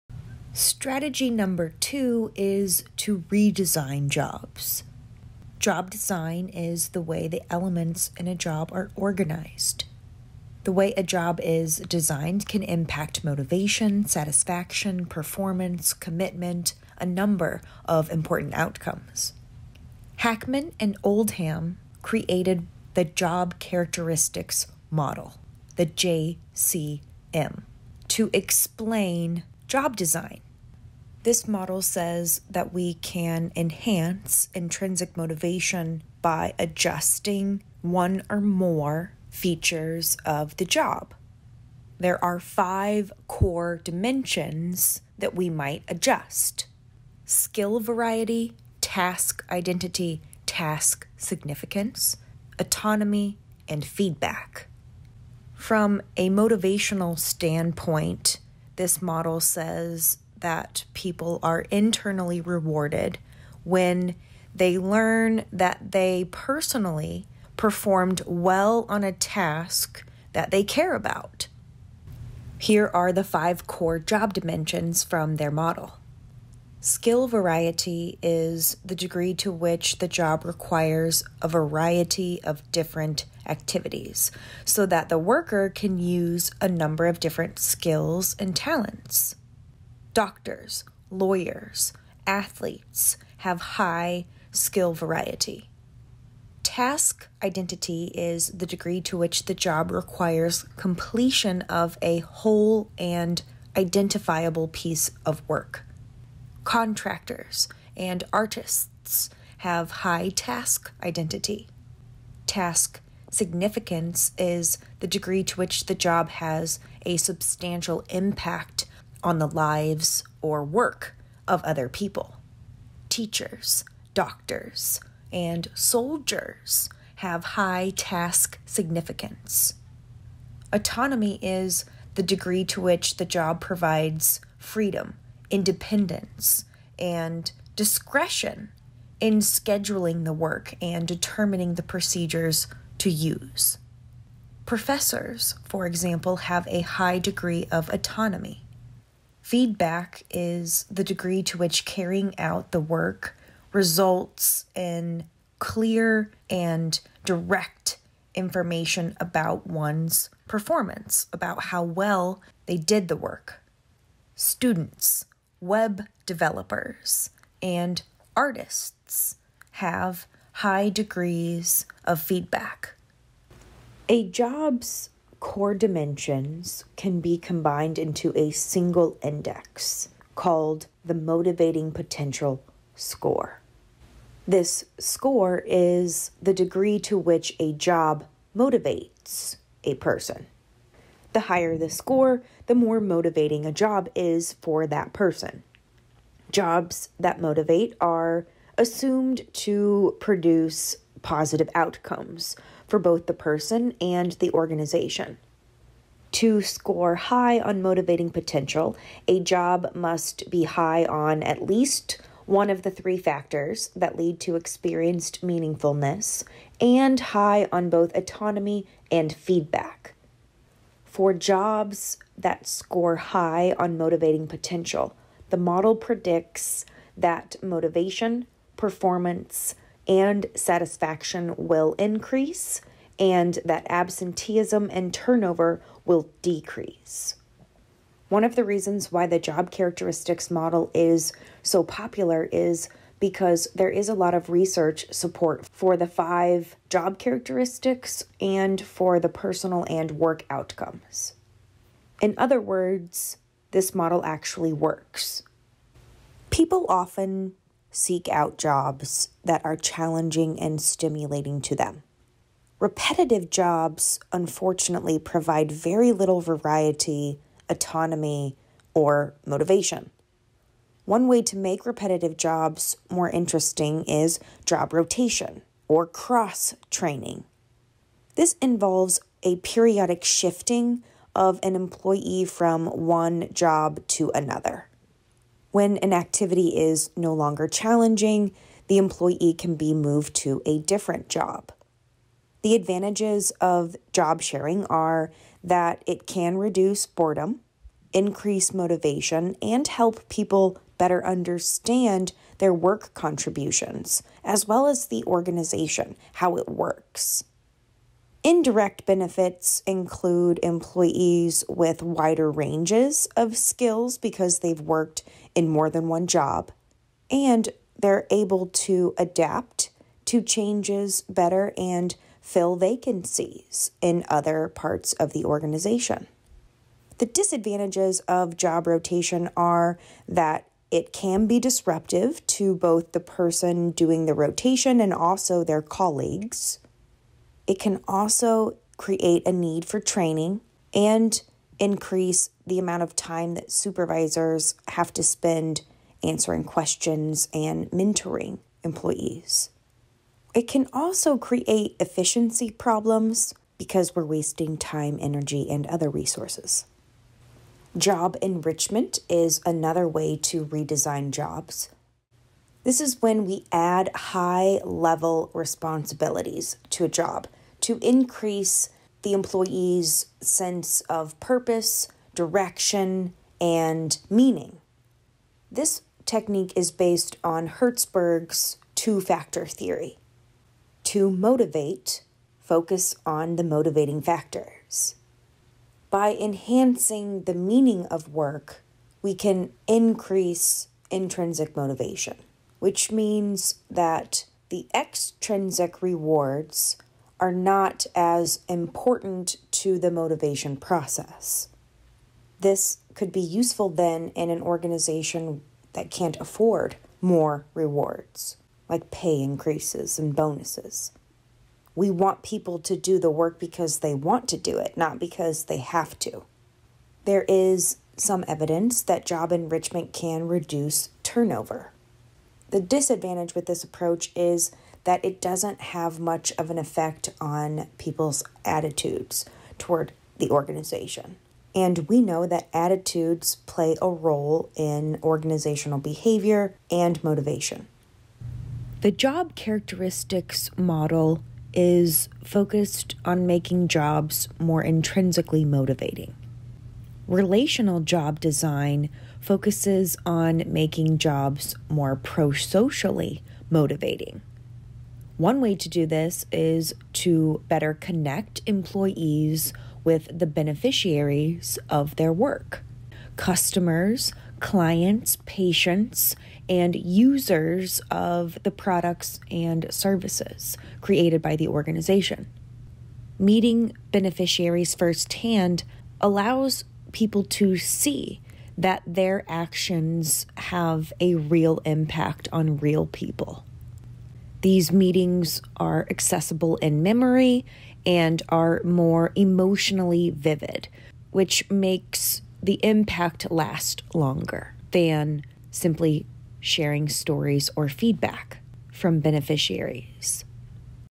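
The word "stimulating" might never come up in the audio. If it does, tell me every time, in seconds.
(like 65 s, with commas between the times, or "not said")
260 s.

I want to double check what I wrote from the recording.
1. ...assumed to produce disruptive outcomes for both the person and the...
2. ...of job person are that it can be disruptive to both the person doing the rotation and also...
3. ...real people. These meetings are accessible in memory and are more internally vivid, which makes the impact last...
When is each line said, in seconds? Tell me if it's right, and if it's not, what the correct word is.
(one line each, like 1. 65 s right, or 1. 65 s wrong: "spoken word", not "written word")
1. 198 s wrong: "positive", not "disruptive"
2. 328 s wrong: "rotation", not "person"
3. 482 s wrong: "emotionally", not "internally".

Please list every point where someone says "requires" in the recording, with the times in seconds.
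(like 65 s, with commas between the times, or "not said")
80 s, 99 s.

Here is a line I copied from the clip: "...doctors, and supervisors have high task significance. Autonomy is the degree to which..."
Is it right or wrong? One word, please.
wrong.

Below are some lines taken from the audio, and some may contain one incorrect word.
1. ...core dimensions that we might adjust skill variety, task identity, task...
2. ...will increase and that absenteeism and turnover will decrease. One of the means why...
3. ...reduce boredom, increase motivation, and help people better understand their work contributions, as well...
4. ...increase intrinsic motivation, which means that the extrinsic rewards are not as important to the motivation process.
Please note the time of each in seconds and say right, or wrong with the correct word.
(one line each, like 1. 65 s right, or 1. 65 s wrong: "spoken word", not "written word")
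1. 43 s right
2. 231 s wrong: "reasons", not "means"
3. 296 s right
4. 389 s right.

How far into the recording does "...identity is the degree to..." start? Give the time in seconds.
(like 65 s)
97 s.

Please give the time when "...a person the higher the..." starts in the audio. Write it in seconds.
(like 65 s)
189 s.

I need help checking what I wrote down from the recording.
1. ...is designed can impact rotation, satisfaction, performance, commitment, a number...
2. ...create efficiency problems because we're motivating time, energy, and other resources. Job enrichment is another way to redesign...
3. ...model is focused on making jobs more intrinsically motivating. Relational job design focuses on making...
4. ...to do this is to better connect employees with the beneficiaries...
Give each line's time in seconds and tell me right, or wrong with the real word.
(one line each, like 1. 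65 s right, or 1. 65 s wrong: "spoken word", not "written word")
1. 11 s wrong: "motivation", not "rotation"
2. 351 s wrong: "wasting", not "motivating"
3. 440 s right
4. 455 s right.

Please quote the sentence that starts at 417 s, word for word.
There is some evidence that job enrichment can reduce turnover.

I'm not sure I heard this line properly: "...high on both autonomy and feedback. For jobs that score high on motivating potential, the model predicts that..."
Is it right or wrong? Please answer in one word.
right.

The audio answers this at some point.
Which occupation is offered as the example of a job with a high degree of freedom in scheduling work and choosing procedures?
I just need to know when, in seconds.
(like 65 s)
144 s.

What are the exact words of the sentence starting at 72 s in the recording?
Here are the five core job dimensions from their model.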